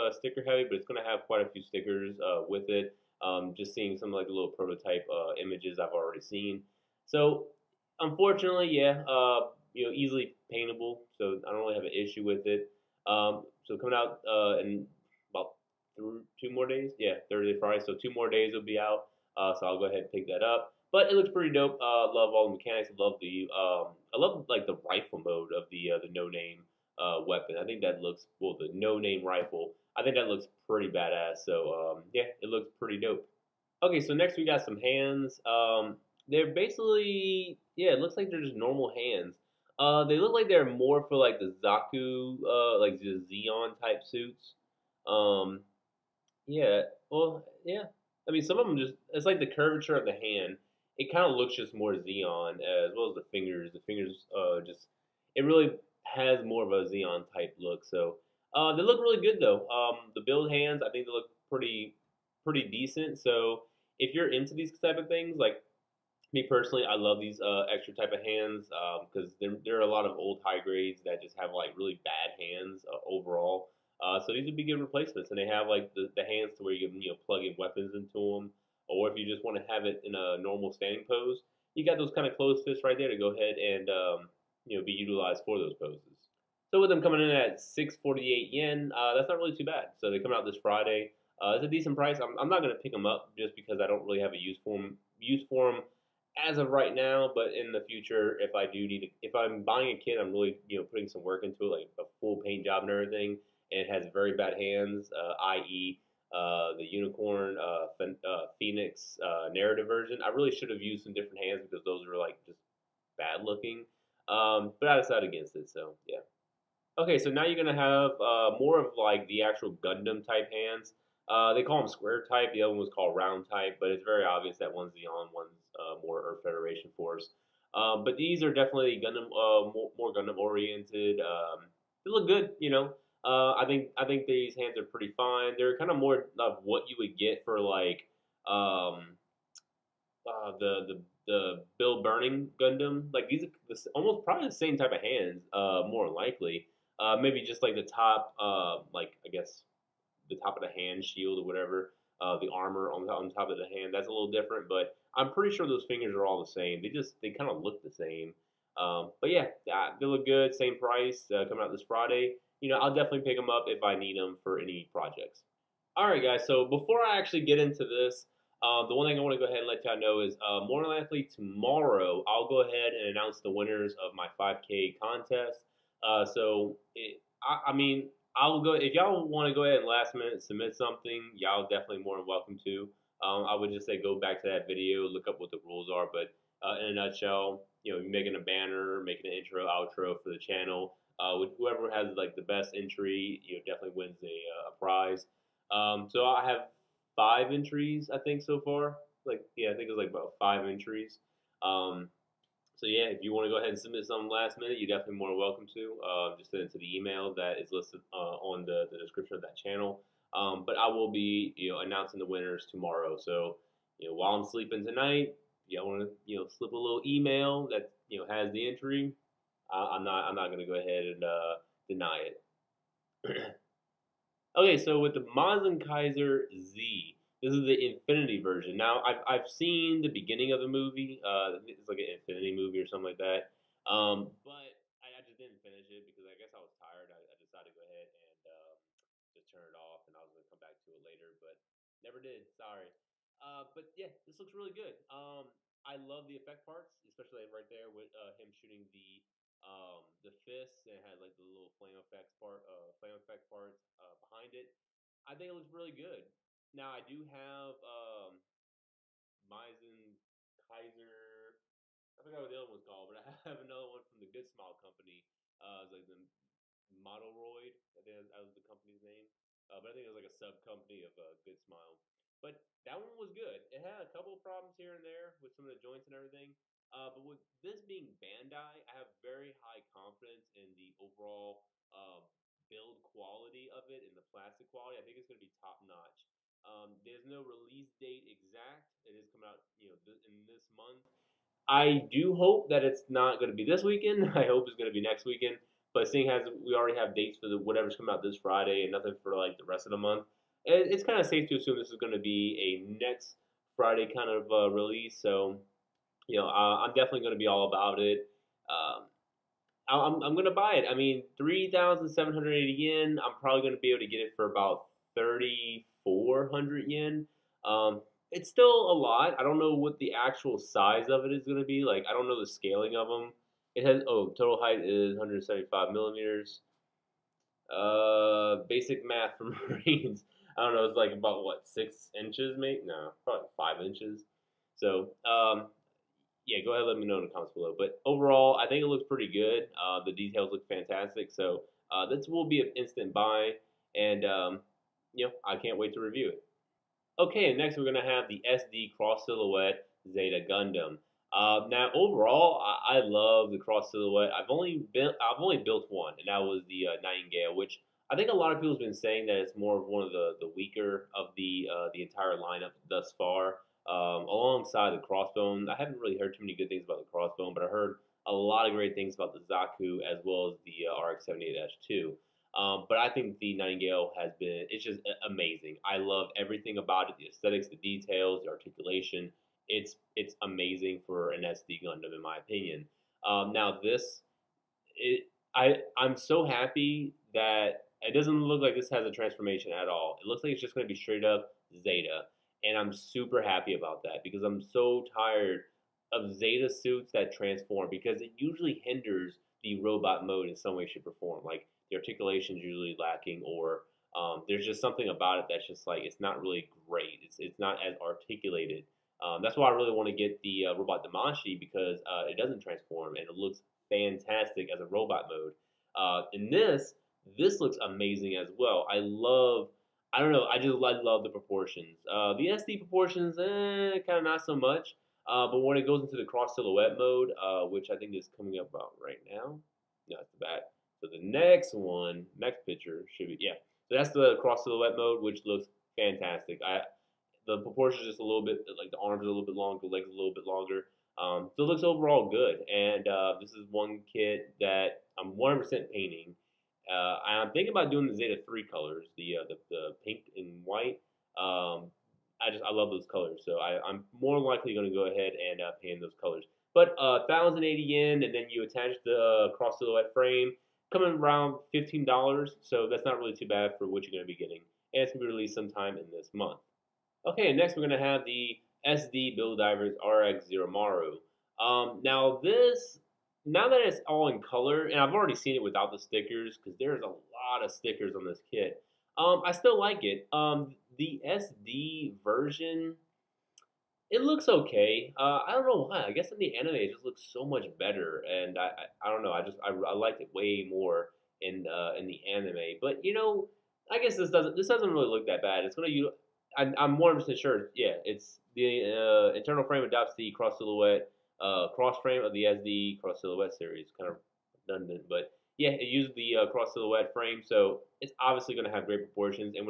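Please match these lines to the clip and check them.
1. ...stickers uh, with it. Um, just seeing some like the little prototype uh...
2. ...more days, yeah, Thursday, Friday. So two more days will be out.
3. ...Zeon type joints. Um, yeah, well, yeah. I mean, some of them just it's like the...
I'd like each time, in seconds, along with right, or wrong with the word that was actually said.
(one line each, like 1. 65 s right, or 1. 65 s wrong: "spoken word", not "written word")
1. 1 s right
2. 16 s right
3. 43 s wrong: "suits", not "joints".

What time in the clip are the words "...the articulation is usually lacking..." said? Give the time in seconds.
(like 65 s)
401 s.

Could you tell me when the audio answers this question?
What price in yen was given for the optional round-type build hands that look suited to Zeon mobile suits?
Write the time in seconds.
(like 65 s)
87 s.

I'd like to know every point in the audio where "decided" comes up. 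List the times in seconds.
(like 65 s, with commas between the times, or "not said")
114 s, 237 s.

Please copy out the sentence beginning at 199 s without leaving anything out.
Like, yeah, I think it was like about five entries.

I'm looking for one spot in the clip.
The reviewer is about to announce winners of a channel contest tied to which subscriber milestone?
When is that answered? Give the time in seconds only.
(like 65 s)
174 s.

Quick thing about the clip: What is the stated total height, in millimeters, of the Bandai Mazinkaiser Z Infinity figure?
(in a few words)
175 millimeters.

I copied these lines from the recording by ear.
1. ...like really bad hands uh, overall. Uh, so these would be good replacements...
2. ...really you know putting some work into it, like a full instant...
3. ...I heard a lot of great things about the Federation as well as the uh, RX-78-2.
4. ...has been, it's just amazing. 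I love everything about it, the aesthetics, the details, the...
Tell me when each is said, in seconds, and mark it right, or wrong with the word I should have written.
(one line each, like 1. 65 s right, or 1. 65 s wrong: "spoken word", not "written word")
1. 71 s right
2. 100 s wrong: "paint", not "instant"
3. 367 s wrong: "Zaku", not "Federation"
4. 374 s right.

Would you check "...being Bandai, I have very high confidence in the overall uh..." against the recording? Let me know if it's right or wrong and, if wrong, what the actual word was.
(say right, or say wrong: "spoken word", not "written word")
right.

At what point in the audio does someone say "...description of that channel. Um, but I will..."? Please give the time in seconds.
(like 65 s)
208 s.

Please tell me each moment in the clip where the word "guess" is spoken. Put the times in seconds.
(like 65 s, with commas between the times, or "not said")
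149 s, 236 s, 486 s, 493 s.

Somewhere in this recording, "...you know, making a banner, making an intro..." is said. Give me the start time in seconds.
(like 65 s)
187 s.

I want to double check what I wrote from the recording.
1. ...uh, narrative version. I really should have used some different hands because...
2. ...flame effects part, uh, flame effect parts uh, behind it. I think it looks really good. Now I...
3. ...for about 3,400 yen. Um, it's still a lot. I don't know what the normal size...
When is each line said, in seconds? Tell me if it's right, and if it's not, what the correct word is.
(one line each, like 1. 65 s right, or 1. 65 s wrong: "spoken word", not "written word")
1. 109 s right
2. 251 s right
3. 314 s wrong: "actual", not "normal".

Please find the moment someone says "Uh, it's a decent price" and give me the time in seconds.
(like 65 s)
91 s.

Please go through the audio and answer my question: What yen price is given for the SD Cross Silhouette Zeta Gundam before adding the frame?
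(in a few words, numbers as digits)
1,080 yen.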